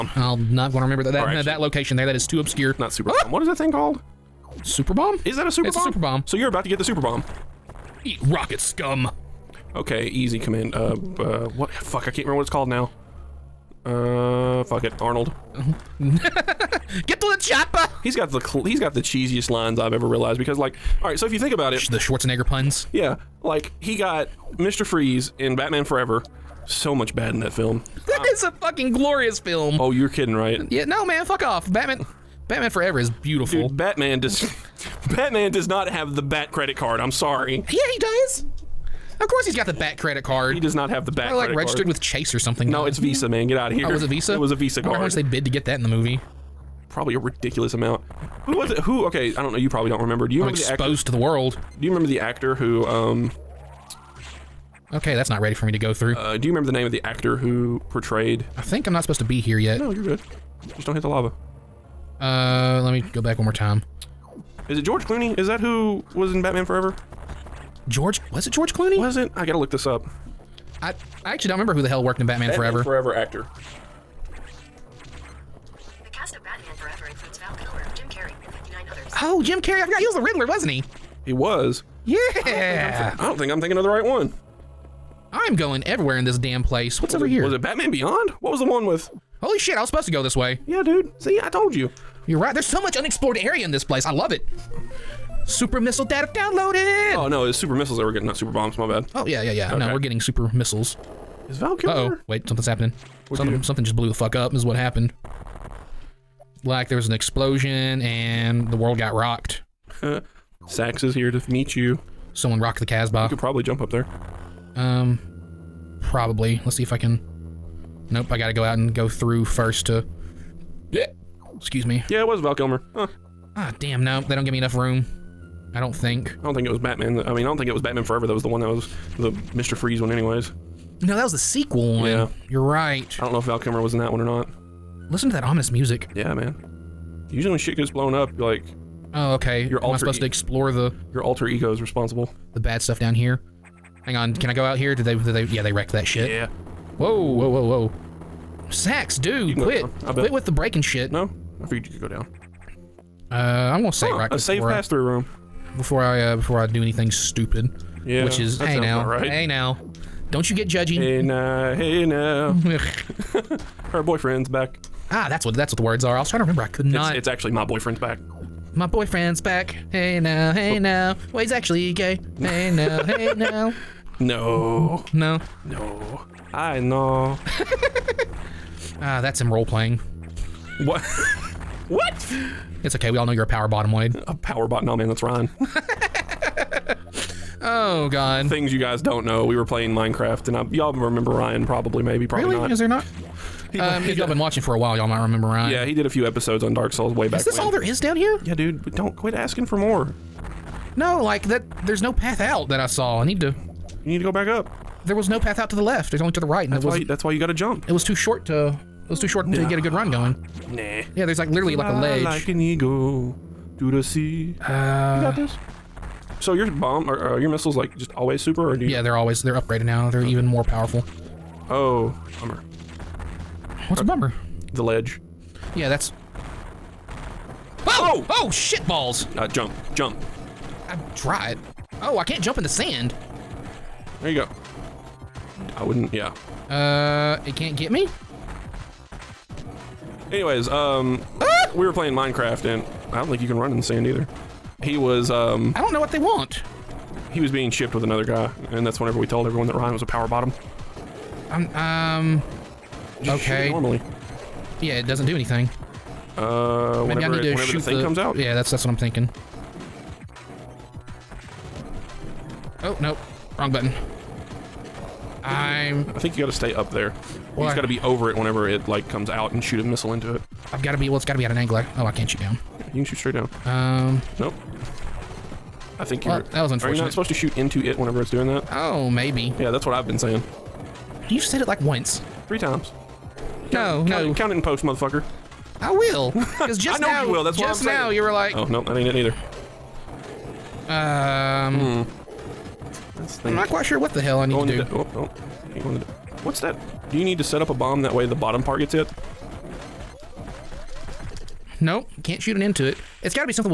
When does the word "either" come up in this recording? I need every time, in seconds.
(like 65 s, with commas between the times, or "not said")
244 s, 289 s.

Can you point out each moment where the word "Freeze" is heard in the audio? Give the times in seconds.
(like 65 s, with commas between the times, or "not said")
24 s, 129 s.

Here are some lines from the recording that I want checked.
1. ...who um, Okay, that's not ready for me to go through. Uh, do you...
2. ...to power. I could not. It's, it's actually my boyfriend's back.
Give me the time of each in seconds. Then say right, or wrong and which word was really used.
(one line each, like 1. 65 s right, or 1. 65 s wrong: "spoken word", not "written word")
1. 52 s right
2. 166 s wrong: "remember", not "power".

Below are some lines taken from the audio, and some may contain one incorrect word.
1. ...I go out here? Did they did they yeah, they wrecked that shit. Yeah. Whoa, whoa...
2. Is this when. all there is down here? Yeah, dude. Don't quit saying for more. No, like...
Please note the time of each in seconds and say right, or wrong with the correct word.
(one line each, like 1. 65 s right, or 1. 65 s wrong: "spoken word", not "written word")
1. 144 s right
2. 197 s wrong: "asking", not "saying".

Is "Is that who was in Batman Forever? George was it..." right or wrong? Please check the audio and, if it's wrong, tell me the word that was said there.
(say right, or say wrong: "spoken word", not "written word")
right.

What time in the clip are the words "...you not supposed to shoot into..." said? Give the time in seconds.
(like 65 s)
276 s.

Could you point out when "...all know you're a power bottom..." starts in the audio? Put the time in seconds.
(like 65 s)
183 s.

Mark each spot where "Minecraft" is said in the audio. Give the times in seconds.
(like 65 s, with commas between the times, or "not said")
189 s, 242 s.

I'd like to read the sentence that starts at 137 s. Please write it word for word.
Usually when shit gets blown up, like Oh, okay.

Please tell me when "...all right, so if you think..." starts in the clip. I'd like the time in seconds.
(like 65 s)
21 s.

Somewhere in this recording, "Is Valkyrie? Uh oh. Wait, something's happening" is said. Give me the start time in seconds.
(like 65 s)
101 s.